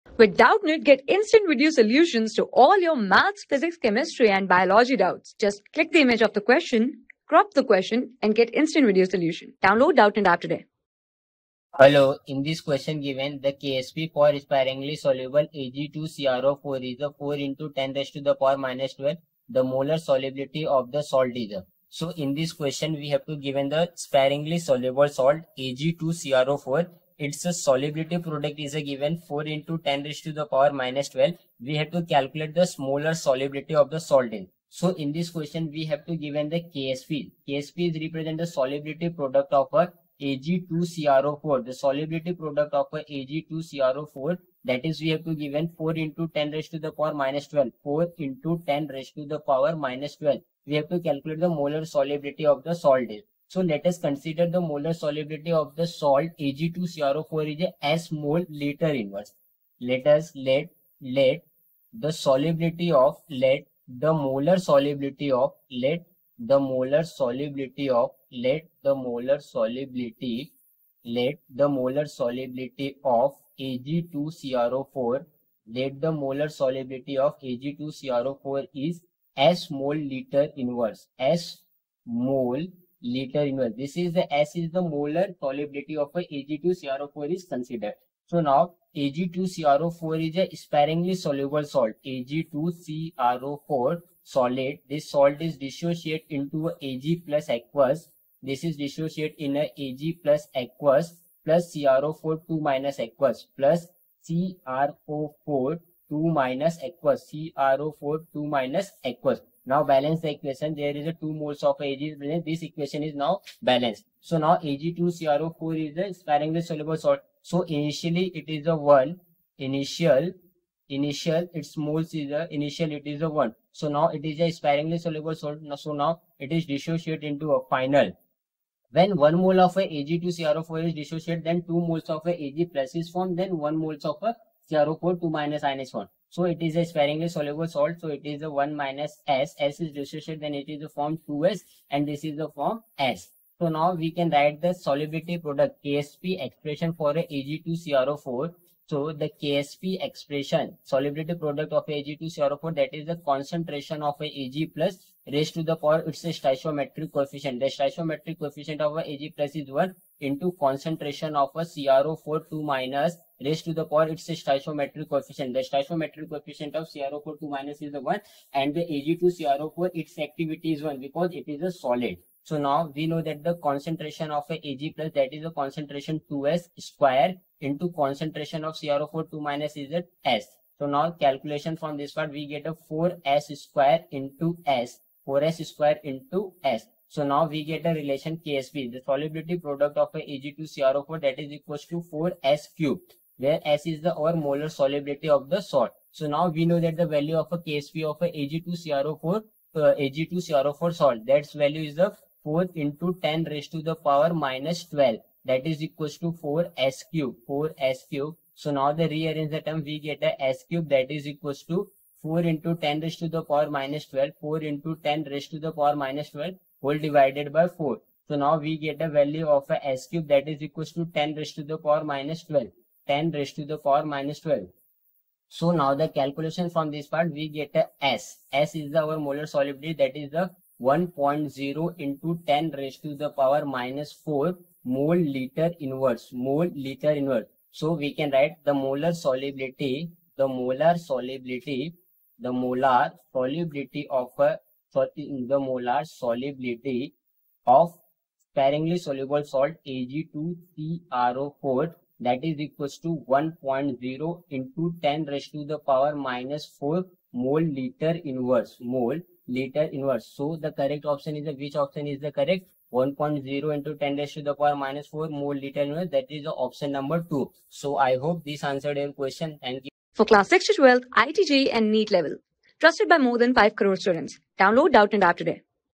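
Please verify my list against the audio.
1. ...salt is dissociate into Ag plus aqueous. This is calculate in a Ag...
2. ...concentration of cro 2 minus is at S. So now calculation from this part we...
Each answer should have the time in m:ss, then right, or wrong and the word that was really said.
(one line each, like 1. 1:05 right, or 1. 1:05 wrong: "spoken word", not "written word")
1. 1:35 wrong: "dissociate", not "calculate"
2. 2:57 right.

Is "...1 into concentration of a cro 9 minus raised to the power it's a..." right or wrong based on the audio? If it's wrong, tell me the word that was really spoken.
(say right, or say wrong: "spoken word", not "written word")
wrong: "2", not "9".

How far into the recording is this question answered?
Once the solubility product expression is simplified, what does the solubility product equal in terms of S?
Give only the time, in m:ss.
3:12.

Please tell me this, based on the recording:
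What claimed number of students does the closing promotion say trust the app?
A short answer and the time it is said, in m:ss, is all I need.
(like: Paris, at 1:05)
5 crore, at 4:33.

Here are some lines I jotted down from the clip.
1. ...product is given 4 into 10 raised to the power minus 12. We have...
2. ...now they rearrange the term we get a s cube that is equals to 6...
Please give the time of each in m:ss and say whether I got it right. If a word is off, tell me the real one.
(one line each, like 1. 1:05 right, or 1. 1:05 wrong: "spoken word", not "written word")
1. 0:28 right
2. 3:28 wrong: "4", not "6".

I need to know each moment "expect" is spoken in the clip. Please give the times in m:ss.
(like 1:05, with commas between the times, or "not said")
not said.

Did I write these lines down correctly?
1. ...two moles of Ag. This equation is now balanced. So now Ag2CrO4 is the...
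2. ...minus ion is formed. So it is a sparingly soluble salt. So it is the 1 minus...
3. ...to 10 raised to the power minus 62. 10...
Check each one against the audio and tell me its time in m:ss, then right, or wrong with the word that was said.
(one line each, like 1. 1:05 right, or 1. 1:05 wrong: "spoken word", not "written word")
1. 1:51 right
2. 2:15 right
3. 3:40 wrong: "12", not "62".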